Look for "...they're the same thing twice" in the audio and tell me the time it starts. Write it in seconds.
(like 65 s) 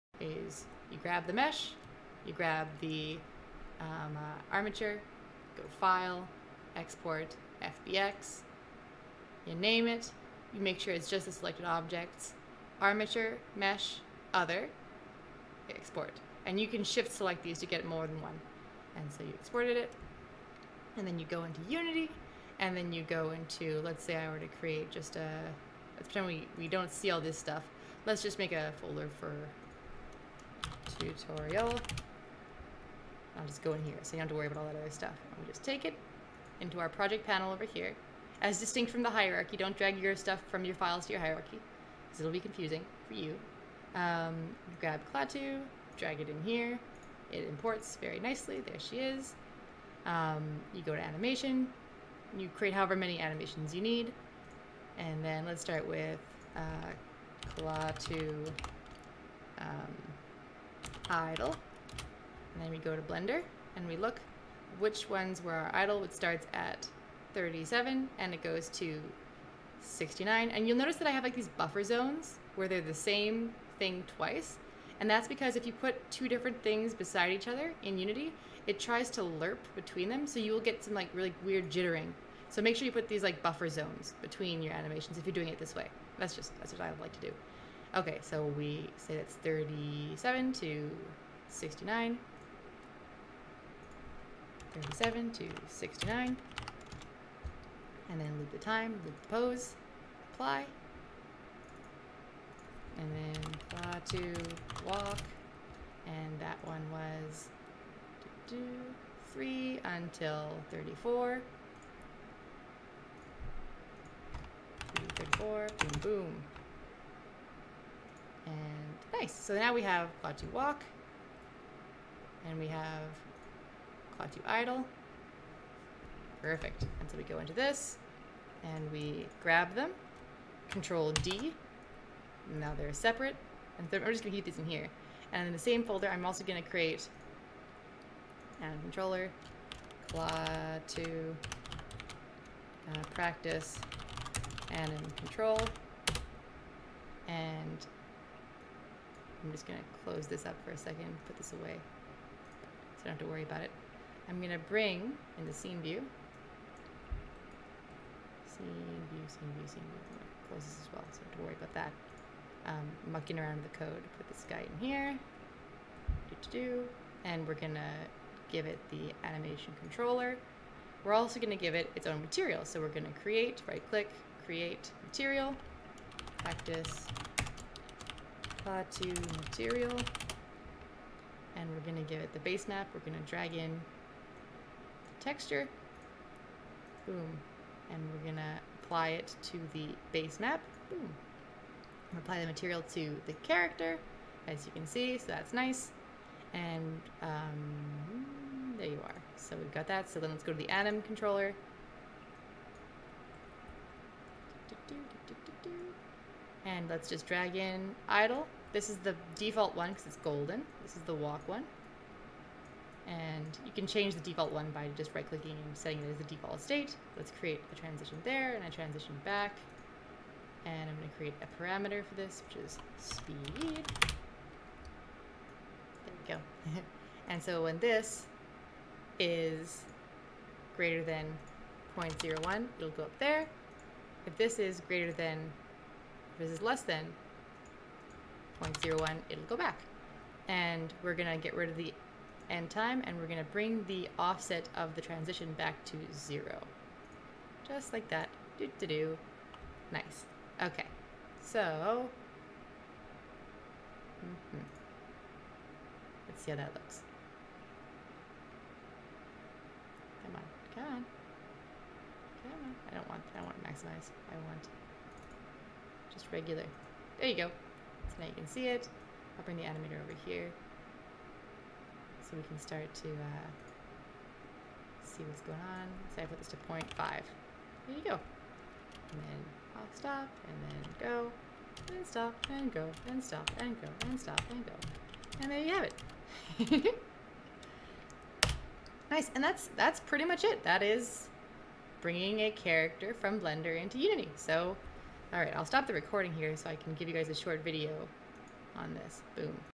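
72 s.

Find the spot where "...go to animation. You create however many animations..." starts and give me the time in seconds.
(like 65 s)
50 s.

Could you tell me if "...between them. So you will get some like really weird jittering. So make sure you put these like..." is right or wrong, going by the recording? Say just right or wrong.
right.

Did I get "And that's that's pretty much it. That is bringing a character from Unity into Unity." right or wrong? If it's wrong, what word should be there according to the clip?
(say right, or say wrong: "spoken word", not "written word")
wrong: "Blender", not "Unity".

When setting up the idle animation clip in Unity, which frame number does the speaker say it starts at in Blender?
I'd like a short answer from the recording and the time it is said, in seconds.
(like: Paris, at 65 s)
37, at 66 s.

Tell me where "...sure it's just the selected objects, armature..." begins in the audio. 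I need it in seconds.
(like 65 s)
10 s.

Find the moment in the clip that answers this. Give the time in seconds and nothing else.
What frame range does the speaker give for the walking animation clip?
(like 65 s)
109 s.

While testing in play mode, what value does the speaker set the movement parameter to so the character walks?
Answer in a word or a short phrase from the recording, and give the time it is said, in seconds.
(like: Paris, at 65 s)
0.5, at 276 s.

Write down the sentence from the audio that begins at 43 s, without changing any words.
Um, grab Klaatu, drag it in here.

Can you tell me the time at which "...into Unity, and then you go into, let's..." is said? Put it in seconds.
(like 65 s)
21 s.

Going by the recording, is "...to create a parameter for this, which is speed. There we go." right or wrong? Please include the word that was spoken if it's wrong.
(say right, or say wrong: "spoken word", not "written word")
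right.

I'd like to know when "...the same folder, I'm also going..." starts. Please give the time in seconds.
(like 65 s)
135 s.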